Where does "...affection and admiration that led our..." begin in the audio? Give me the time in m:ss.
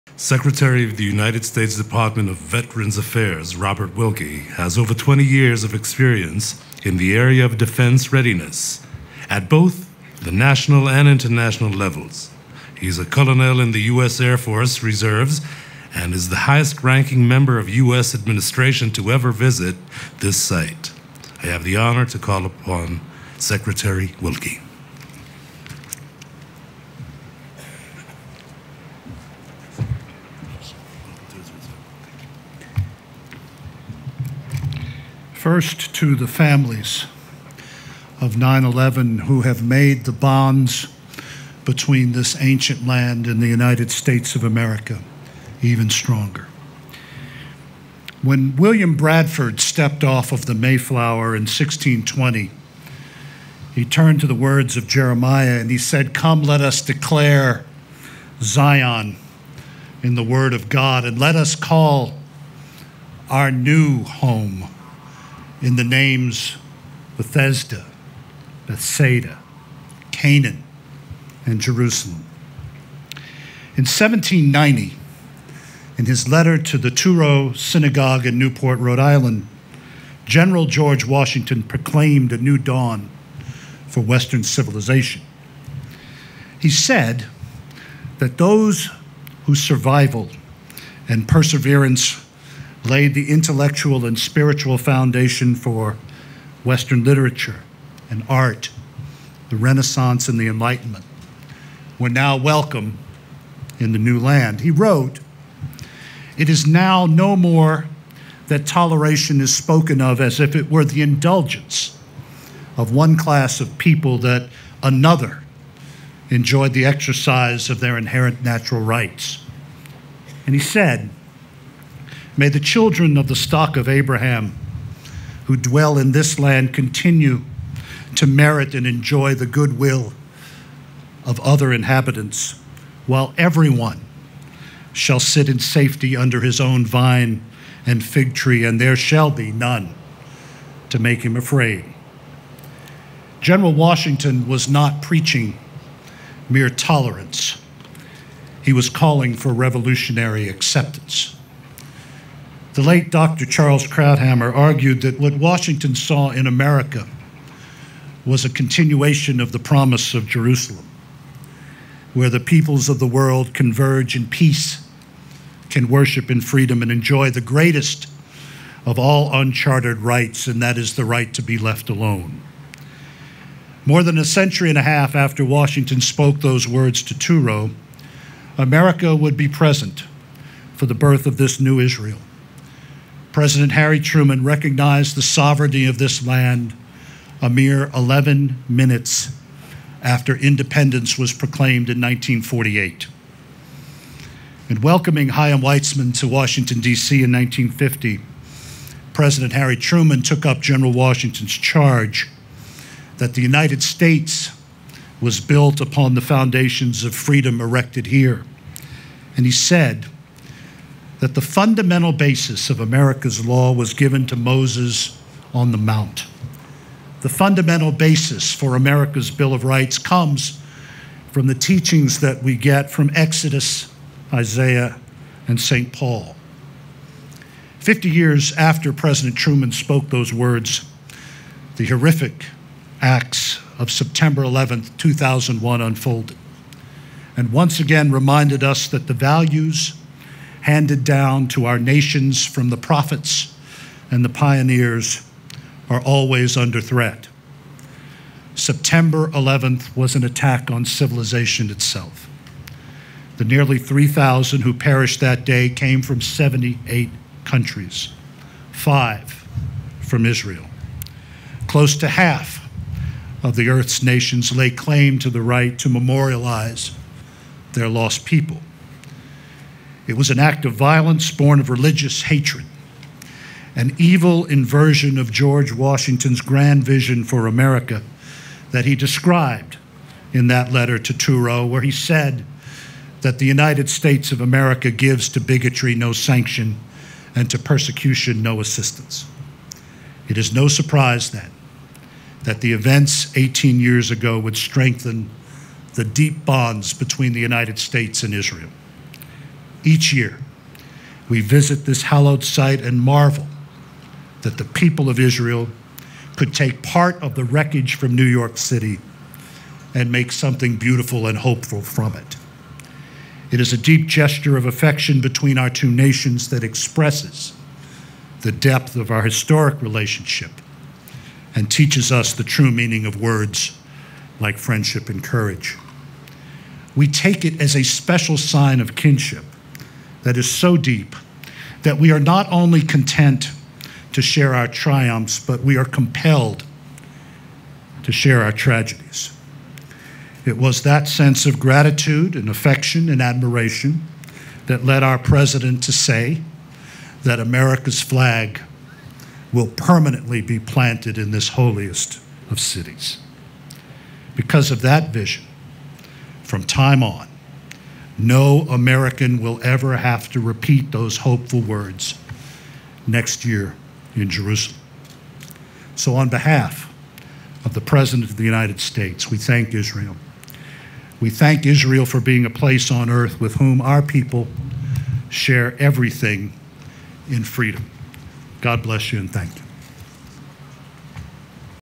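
5:42.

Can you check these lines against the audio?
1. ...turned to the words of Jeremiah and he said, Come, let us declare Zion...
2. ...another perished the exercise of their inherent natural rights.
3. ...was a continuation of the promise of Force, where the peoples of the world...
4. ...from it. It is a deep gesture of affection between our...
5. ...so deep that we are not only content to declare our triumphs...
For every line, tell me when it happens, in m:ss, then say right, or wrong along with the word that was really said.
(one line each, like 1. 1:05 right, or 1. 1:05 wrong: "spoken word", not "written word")
1. 0:53 right
2. 1:54 wrong: "enjoyed", not "perished"
3. 2:38 wrong: "Jerusalem", not "Force"
4. 5:11 right
5. 5:30 wrong: "share", not "declare".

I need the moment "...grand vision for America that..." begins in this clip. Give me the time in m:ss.
4:36.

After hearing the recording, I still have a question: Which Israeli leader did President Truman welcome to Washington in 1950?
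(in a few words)
Chaim Weizmann.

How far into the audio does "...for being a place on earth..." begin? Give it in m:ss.
6:12.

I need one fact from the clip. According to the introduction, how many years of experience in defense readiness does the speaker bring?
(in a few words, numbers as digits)
over 20 years.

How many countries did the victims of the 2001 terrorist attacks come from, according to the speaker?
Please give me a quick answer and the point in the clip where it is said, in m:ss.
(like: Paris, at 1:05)
78, at 4:16.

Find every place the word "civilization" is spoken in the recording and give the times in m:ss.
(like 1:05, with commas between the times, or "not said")
1:24, 4:10.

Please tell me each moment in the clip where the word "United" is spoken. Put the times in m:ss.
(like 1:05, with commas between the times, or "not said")
0:01, 0:43, 3:23, 4:43, 4:57, 6:08.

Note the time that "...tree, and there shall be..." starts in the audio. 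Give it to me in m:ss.
2:18.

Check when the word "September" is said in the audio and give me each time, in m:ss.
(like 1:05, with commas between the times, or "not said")
3:53, 4:08.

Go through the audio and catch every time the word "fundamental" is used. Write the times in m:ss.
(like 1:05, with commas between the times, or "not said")
3:31, 3:37.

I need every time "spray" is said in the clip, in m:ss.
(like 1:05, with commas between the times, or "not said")
not said.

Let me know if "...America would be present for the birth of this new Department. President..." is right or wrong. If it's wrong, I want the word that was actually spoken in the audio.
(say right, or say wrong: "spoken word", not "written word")
wrong: "Israel", not "Department".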